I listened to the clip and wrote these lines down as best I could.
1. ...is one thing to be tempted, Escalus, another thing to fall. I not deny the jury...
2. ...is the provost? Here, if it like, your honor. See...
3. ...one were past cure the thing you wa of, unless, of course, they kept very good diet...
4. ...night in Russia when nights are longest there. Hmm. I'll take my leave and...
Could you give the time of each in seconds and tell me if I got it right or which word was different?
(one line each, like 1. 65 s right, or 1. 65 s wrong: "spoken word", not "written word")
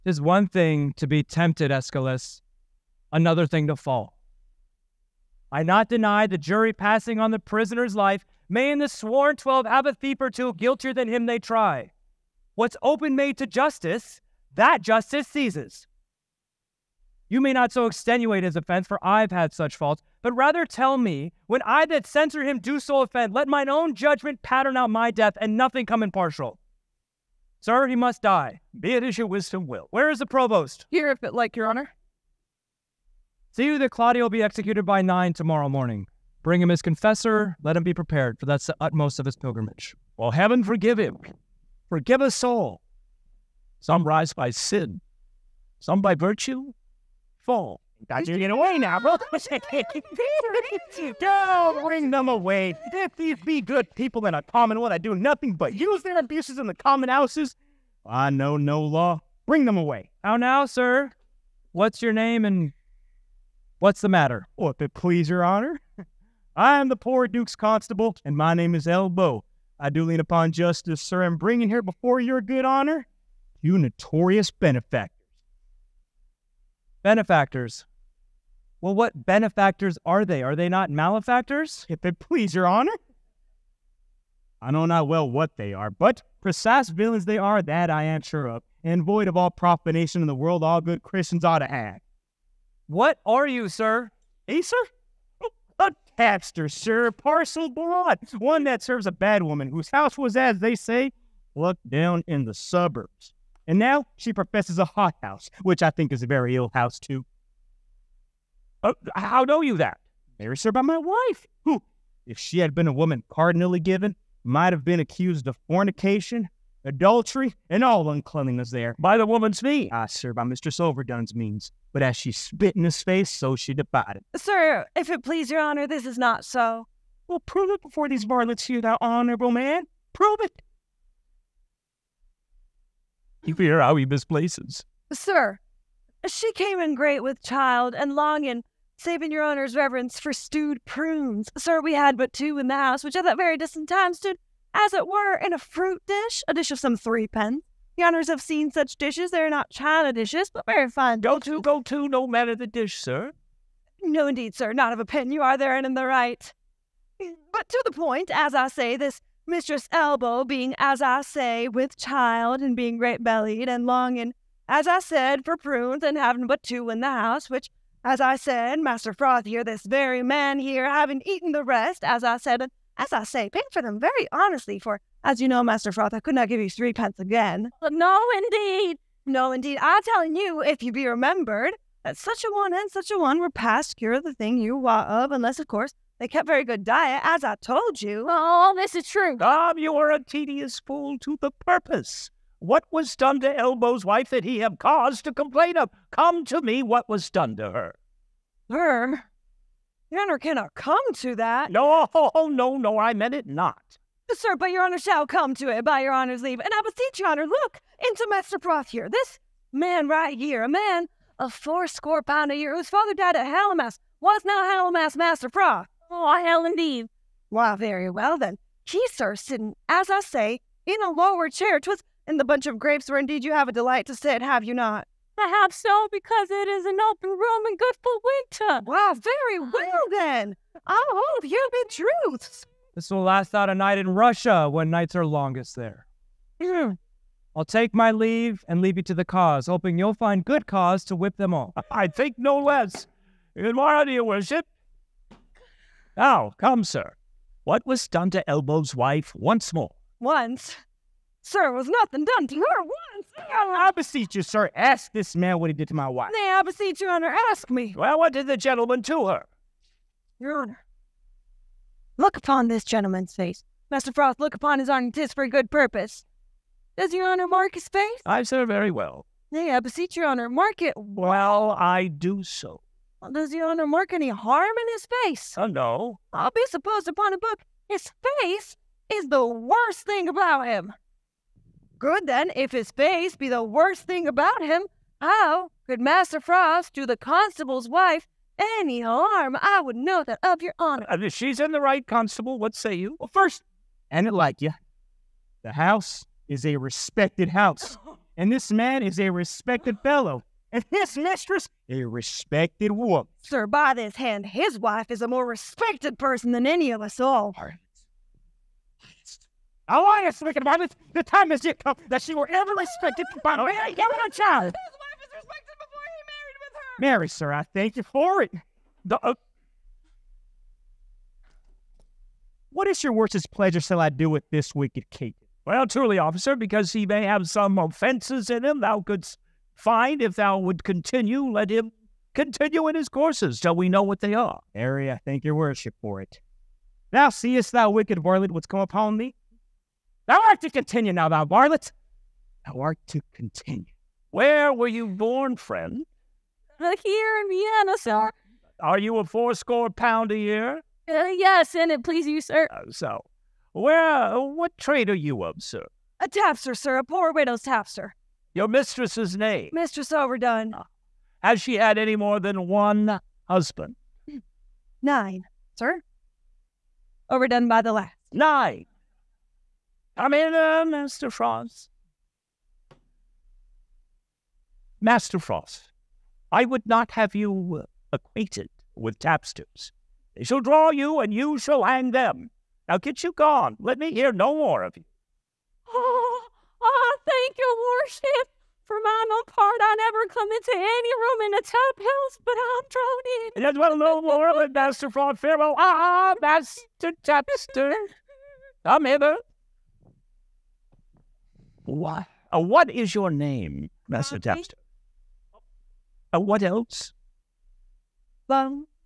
1. 0 s right
2. 30 s right
3. 183 s right
4. 233 s right.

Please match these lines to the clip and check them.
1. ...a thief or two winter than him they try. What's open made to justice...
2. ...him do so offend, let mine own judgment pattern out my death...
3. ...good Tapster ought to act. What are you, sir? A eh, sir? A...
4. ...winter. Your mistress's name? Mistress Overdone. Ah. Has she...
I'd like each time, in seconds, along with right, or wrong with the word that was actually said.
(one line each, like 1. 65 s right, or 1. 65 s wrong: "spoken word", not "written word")
1. 9 s wrong: "guiltier", not "winter"
2. 22 s right
3. 90 s wrong: "Christians", not "Tapster"
4. 357 s wrong: "tapster", not "winter".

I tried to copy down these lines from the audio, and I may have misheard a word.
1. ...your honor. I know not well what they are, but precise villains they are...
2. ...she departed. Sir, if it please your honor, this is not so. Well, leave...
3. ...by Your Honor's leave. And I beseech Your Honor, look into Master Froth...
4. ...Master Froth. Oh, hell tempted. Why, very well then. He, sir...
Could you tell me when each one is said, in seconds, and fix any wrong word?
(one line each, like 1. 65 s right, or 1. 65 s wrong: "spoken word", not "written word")
1. 82 s right
2. 123 s wrong: "prove", not "leave"
3. 205 s right
4. 215 s wrong: "indeed", not "tempted".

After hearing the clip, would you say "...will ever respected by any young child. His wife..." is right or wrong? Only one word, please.
right.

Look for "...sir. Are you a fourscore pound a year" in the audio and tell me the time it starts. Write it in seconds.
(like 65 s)
347 s.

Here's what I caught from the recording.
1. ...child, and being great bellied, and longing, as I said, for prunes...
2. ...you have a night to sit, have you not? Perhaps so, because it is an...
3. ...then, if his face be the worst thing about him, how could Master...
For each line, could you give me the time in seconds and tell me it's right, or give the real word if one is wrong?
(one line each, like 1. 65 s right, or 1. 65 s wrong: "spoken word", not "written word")
1. 161 s right
2. 223 s wrong: "delight", not "night"
3. 282 s right.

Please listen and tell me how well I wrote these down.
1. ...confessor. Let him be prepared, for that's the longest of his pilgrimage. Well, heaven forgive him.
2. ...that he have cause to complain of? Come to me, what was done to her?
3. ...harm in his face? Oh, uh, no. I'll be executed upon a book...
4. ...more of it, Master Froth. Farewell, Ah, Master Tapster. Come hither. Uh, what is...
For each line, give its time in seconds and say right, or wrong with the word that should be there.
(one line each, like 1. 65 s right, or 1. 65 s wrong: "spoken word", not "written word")
1. 36 s wrong: "utmost", not "longest"
2. 194 s right
3. 274 s wrong: "supposed", not "executed"
4. 394 s right.